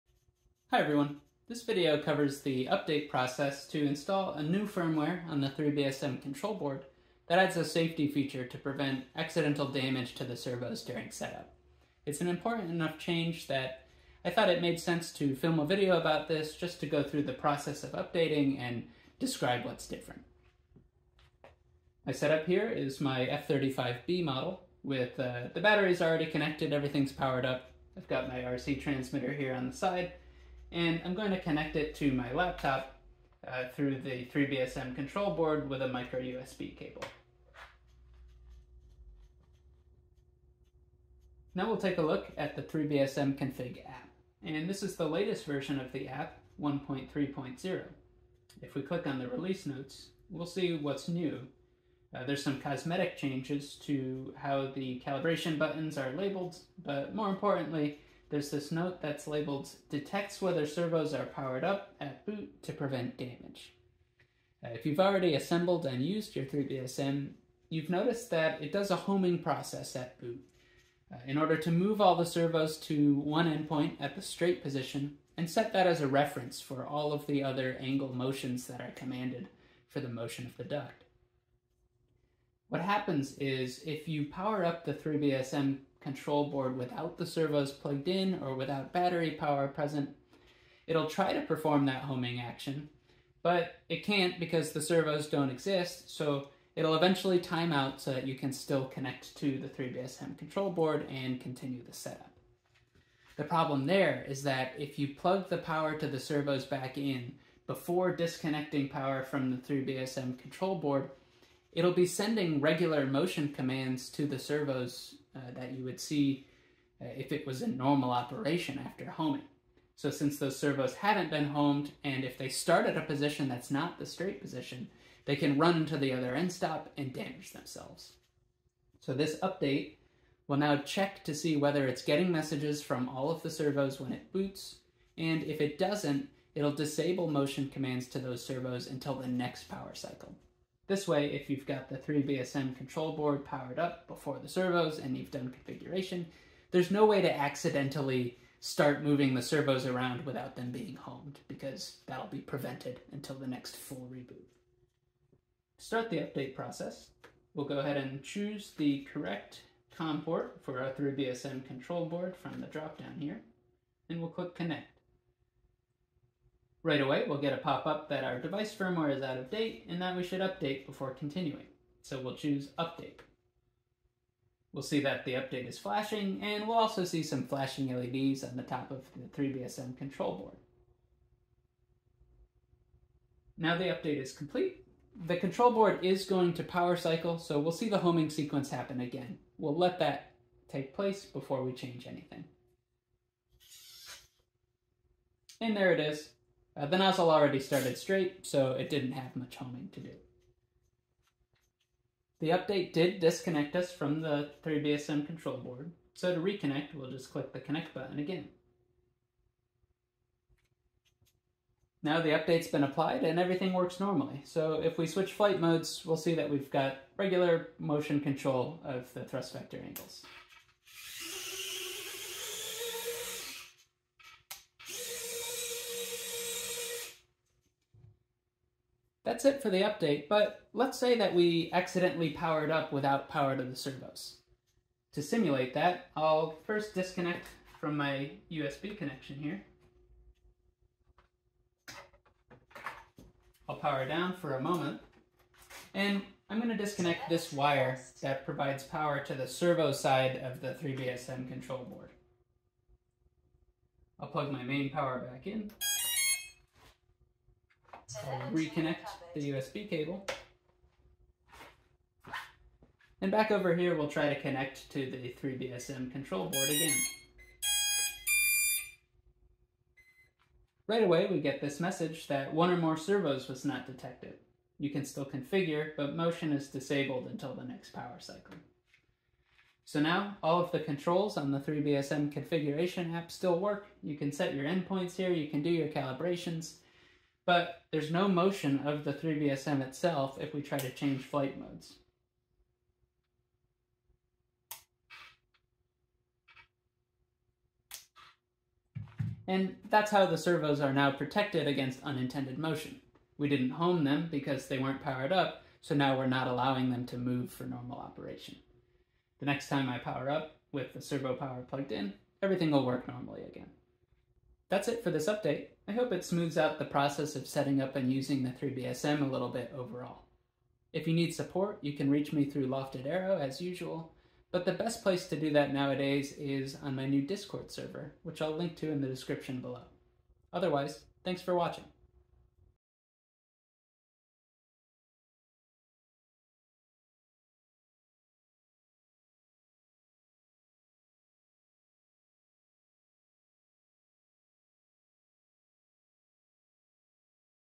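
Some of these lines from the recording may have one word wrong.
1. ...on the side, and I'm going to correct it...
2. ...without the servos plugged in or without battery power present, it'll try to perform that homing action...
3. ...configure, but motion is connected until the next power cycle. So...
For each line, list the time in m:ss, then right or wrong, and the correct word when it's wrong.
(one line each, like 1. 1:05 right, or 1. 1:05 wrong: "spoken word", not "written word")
1. 0:29 wrong: "connect", not "correct"
2. 1:26 right
3. 4:35 wrong: "disabled", not "connected".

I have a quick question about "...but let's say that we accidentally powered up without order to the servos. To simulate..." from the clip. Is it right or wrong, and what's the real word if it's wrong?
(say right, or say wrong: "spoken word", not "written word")
wrong: "power", not "order".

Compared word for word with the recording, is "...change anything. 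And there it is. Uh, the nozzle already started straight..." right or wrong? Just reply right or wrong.
right.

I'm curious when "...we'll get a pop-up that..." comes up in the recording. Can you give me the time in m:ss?
2:47.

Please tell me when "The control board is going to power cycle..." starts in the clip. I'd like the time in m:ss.
3:05.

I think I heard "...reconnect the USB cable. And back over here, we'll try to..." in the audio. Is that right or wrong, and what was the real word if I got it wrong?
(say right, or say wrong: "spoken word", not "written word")
right.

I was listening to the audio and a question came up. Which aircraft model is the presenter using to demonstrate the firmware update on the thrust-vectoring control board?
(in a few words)
F35B.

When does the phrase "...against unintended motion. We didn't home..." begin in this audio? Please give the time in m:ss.
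5:01.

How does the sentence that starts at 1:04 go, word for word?
Uh, if you've already assembled and used your 3BSM, you've noticed that it does a homing process at boot.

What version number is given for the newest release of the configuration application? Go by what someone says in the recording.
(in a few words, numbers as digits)
1.3.0.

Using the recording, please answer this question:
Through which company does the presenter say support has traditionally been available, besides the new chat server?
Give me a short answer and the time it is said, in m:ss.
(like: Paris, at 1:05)
Lofted Aero, at 5:22.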